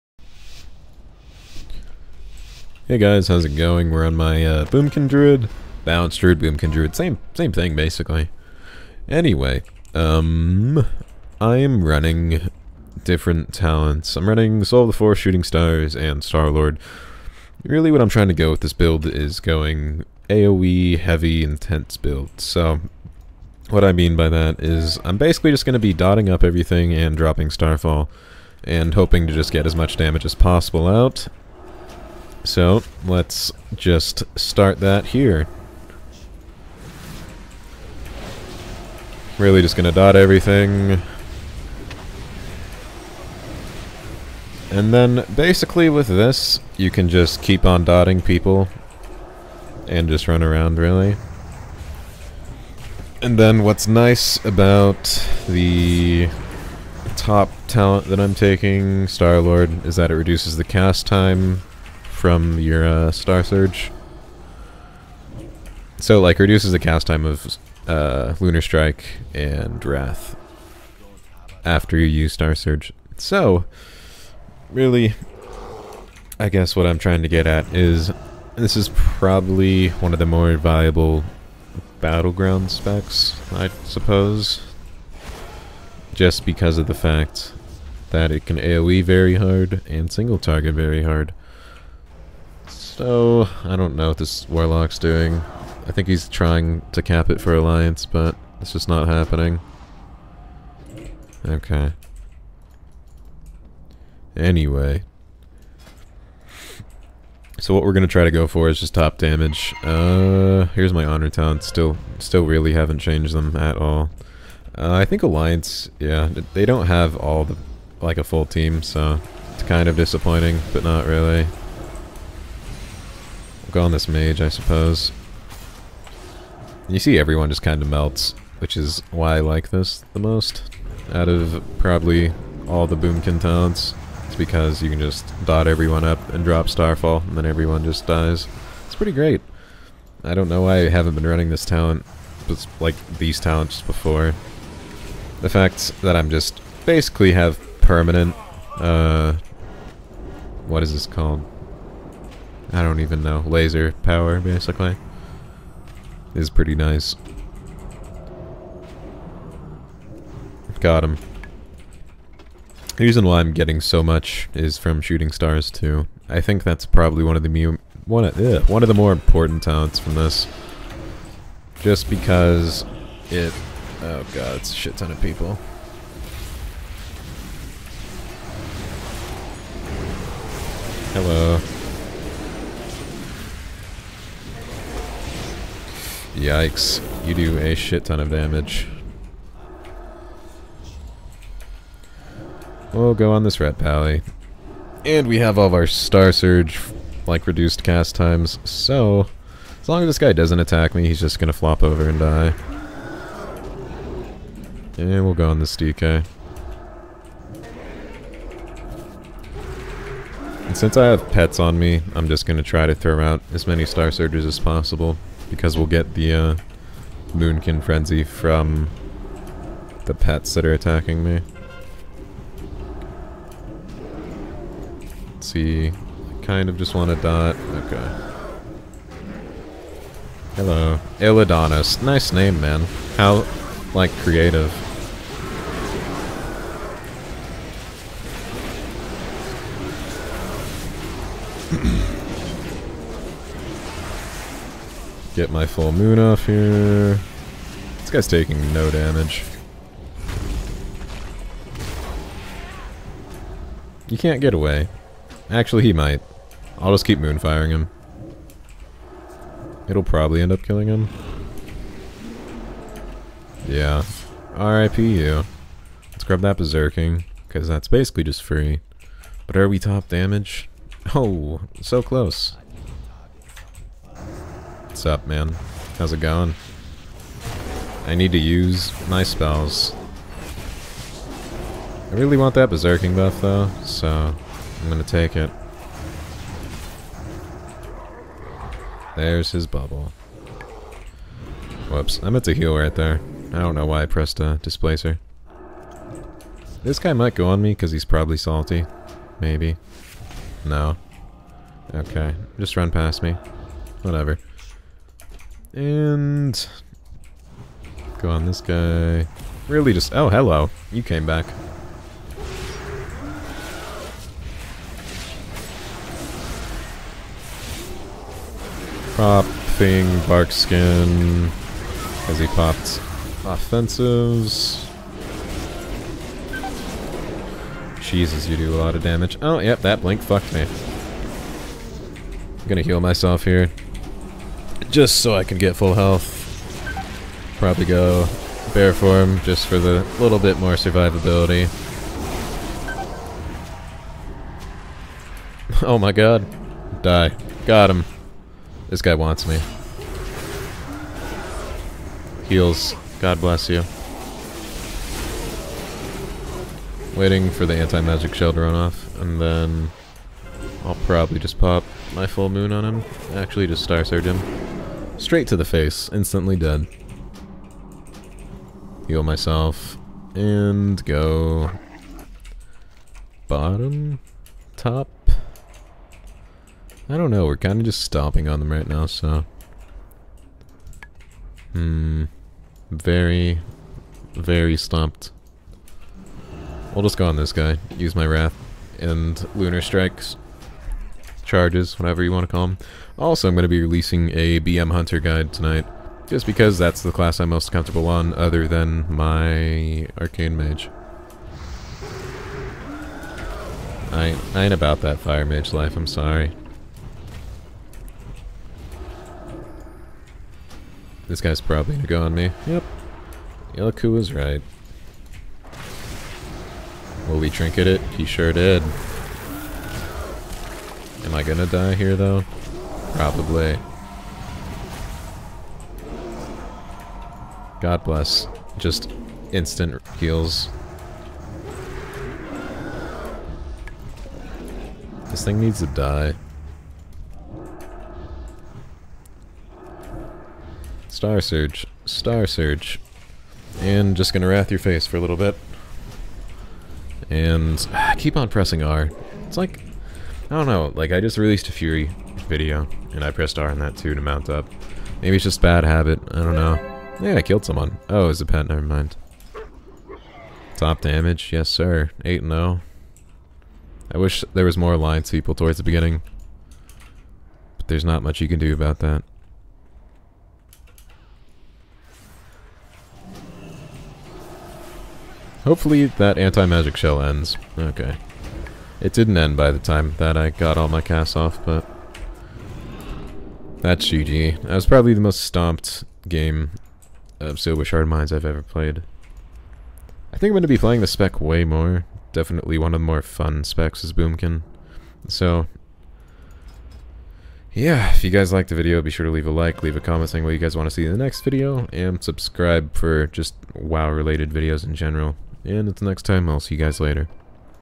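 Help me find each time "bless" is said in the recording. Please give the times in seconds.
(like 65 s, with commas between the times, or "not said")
353 s, 428 s.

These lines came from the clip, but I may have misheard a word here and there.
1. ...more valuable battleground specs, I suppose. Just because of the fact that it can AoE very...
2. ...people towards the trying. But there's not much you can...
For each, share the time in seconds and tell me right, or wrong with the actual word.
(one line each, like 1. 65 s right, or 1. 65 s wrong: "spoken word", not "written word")
1. 80 s right
2. 465 s wrong: "beginning", not "trying".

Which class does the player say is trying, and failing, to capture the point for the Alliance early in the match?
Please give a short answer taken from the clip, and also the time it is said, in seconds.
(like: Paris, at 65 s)
Warlock, at 94 s.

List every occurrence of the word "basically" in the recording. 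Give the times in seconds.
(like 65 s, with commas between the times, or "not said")
7 s, 25 s, 45 s, 146 s, 154 s, 267 s.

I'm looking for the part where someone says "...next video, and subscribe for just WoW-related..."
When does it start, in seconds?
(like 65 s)
501 s.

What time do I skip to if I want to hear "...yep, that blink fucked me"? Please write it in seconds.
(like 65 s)
329 s.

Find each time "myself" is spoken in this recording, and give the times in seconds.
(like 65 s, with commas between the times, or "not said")
332 s, 369 s.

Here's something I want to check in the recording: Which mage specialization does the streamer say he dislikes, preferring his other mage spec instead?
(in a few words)
Fire Mage.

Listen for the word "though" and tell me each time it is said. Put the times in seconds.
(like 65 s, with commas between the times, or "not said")
283 s, 422 s.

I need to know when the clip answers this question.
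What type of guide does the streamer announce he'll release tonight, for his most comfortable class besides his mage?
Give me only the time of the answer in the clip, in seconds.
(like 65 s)
394 s.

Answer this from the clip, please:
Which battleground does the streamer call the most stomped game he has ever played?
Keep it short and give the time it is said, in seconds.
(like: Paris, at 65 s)
Silvershard Mines, at 487 s.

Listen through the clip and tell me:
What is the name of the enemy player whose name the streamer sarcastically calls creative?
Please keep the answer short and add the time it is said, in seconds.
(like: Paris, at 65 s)
Iladonis, at 231 s.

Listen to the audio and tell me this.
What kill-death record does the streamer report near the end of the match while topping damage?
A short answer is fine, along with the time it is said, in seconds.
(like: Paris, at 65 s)
8 and 0, at 462 s.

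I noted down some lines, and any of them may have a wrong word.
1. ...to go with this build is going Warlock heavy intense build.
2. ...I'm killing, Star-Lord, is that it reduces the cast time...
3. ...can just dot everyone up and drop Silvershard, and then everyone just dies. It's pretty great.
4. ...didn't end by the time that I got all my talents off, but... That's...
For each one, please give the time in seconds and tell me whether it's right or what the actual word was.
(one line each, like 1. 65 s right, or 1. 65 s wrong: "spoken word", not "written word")
1. 18 s wrong: "AOE", not "Warlock"
2. 58 s wrong: "taking", not "killing"
3. 134 s wrong: "Starfall", not "Silvershard"
4. 479 s wrong: "casts", not "talents".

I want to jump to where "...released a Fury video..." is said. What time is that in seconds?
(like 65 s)
451 s.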